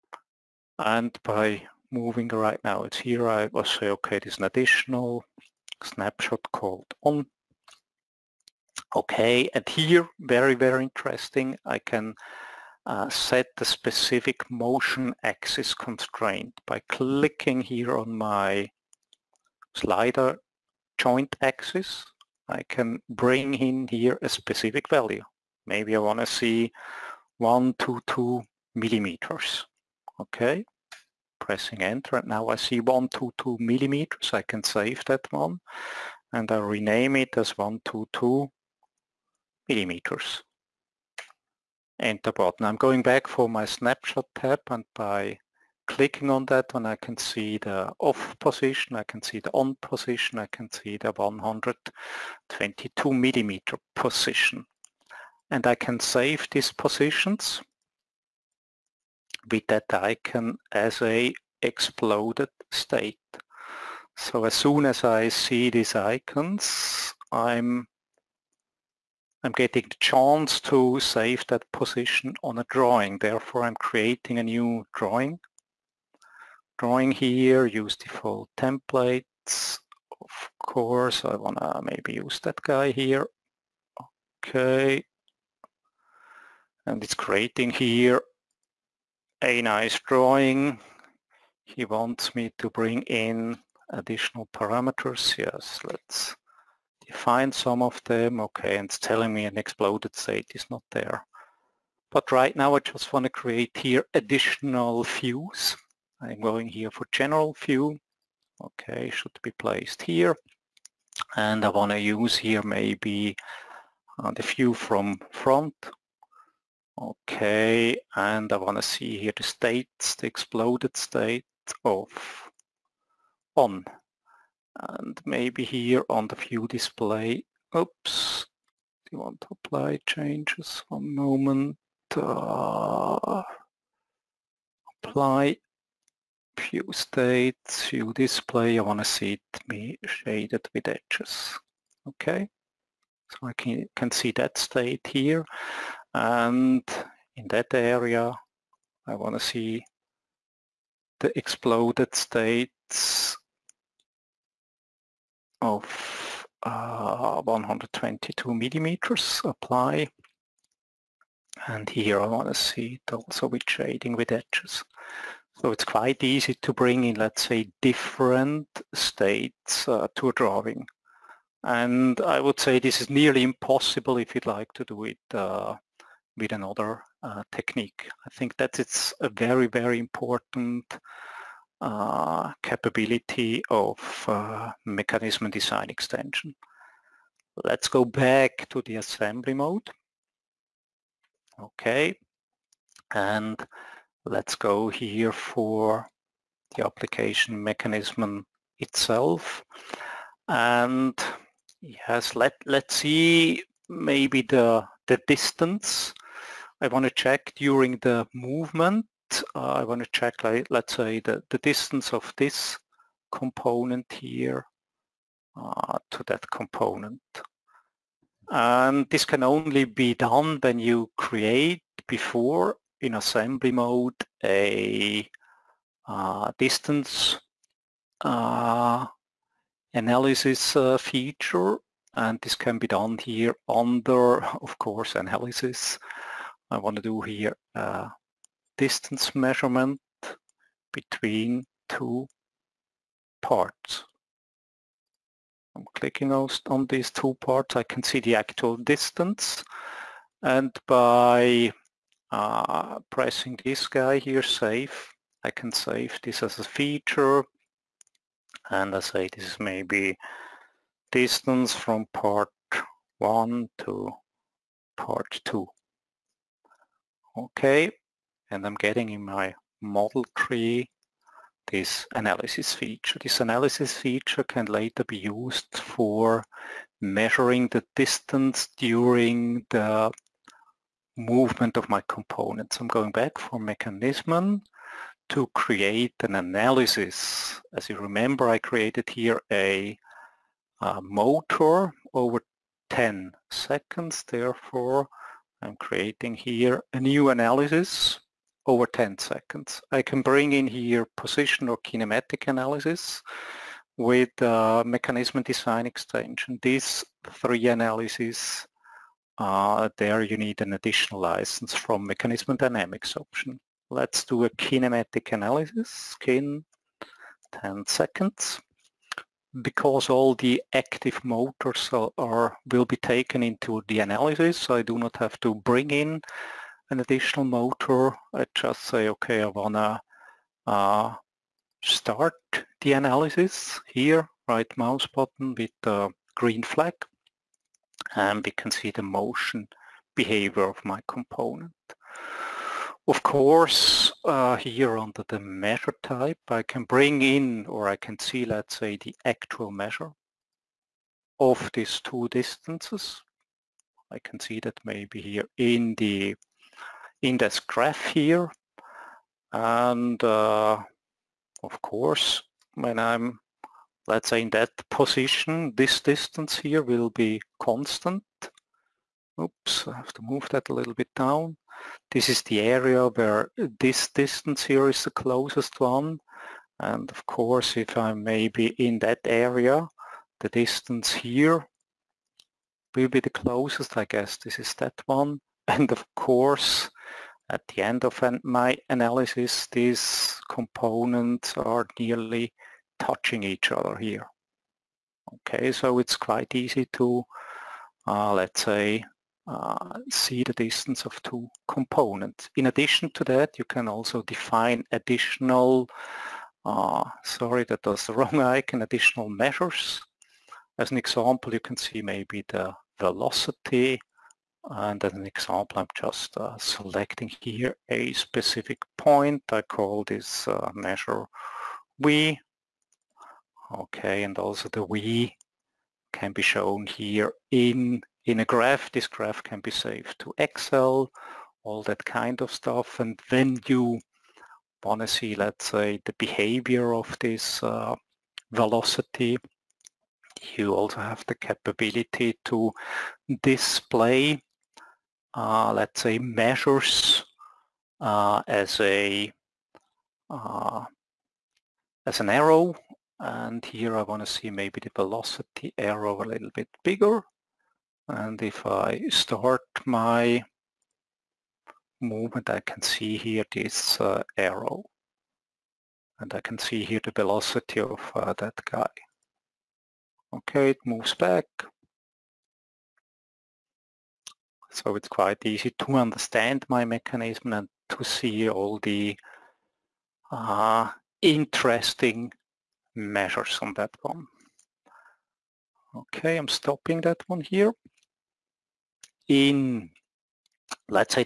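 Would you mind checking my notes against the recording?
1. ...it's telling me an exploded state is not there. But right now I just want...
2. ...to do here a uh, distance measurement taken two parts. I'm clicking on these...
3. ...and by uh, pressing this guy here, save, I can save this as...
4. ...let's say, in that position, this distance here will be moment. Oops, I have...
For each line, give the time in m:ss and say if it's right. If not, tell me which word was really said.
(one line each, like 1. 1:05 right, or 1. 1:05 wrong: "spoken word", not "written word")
1. 1:38 right
2. 3:56 wrong: "between", not "taken"
3. 4:10 right
4. 6:04 wrong: "constant", not "moment".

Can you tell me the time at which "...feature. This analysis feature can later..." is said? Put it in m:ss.
4:32.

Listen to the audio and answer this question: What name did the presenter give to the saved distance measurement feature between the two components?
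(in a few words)
distance from part 1 to part 2.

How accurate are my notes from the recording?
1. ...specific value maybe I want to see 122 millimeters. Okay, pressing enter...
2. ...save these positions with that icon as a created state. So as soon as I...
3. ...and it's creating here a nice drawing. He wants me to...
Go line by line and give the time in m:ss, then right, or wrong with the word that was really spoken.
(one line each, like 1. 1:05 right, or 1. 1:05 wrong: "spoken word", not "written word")
1. 0:24 right
2. 0:55 wrong: "exploded", not "created"
3. 1:26 right.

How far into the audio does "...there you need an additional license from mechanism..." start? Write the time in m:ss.
5:09.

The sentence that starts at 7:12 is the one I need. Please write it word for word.
And then you want to see, let's say, the behavior of this uh, velocity.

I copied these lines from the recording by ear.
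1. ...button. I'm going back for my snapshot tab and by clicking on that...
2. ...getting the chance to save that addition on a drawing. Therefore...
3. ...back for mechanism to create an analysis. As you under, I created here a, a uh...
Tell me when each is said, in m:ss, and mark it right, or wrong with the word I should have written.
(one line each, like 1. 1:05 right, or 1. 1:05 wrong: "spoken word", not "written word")
1. 0:42 right
2. 1:09 wrong: "position", not "addition"
3. 4:43 wrong: "remember", not "under".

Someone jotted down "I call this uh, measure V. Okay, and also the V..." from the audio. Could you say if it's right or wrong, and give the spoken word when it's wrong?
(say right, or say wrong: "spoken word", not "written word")
right.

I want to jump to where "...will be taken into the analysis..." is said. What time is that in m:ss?
5:22.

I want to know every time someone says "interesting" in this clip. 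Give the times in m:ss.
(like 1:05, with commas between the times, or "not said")
0:10, 8:01.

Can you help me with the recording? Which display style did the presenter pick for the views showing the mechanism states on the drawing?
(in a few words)
shaded with edges.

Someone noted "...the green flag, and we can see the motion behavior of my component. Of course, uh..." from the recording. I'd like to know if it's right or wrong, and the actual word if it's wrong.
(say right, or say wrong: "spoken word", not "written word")
right.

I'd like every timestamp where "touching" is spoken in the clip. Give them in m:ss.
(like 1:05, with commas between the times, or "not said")
6:32.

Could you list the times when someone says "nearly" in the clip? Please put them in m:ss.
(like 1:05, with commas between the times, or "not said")
2:53, 6:31.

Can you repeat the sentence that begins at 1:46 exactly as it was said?
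I'm going here for general view.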